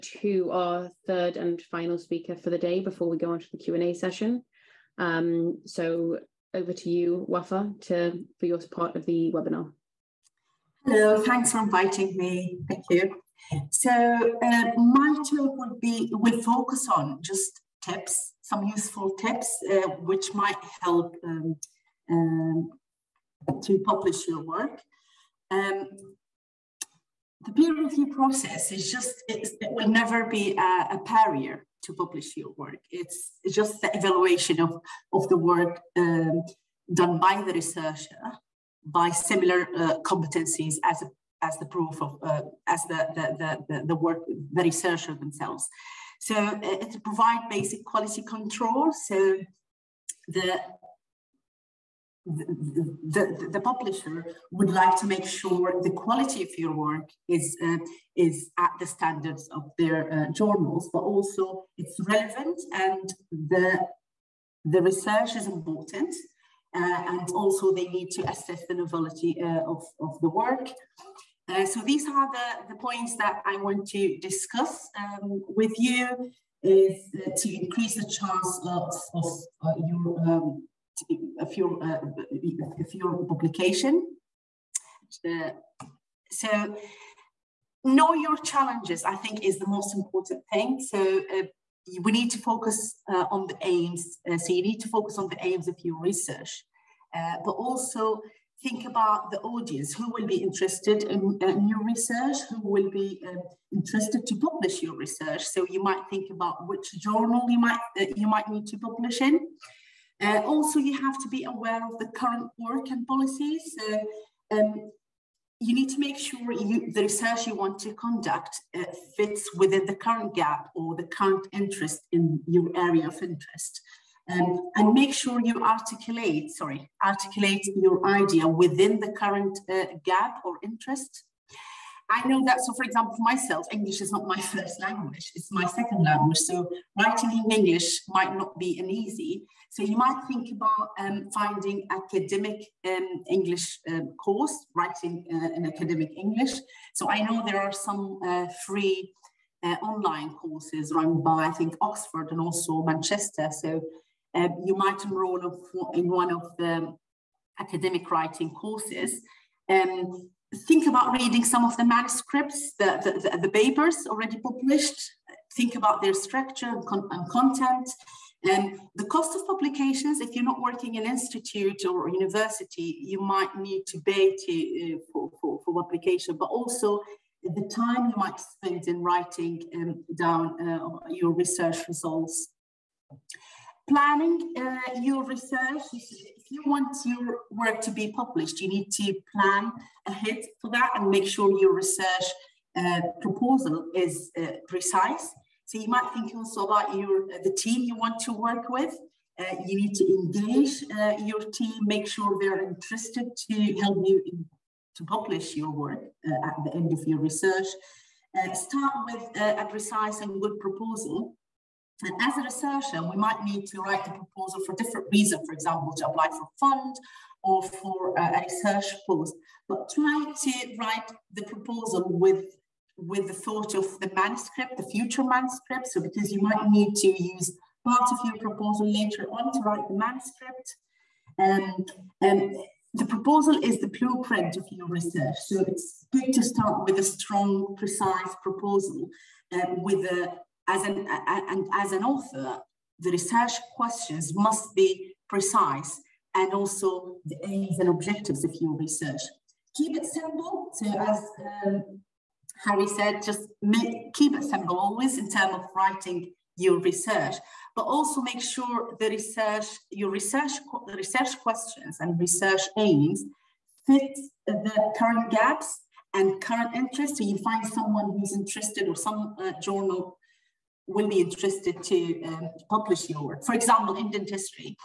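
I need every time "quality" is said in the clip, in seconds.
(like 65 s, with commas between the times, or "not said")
47 s, 55 s.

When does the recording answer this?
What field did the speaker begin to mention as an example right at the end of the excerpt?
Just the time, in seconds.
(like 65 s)
274 s.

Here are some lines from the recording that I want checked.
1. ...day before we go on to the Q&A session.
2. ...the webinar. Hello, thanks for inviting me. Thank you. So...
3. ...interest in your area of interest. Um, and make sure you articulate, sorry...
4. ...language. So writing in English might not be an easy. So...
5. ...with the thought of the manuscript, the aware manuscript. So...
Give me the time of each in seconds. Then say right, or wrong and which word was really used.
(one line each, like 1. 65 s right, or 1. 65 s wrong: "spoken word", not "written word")
1. 2 s right
2. 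9 s right
3. 121 s right
4. 136 s right
5. 222 s wrong: "future", not "aware".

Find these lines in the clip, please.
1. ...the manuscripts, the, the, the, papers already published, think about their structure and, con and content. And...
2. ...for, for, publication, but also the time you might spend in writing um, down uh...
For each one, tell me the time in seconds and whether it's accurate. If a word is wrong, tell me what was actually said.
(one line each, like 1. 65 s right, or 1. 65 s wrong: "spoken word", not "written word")
1. 161 s right
2. 175 s right.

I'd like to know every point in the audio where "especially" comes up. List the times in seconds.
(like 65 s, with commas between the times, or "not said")
not said.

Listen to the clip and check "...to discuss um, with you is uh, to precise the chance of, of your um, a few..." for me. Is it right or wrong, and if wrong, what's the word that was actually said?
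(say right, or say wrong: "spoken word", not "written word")
wrong: "increase", not "precise".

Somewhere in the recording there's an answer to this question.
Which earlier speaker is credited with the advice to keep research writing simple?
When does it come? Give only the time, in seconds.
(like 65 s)
252 s.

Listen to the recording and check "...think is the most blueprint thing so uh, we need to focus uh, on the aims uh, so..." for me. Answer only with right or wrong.
wrong.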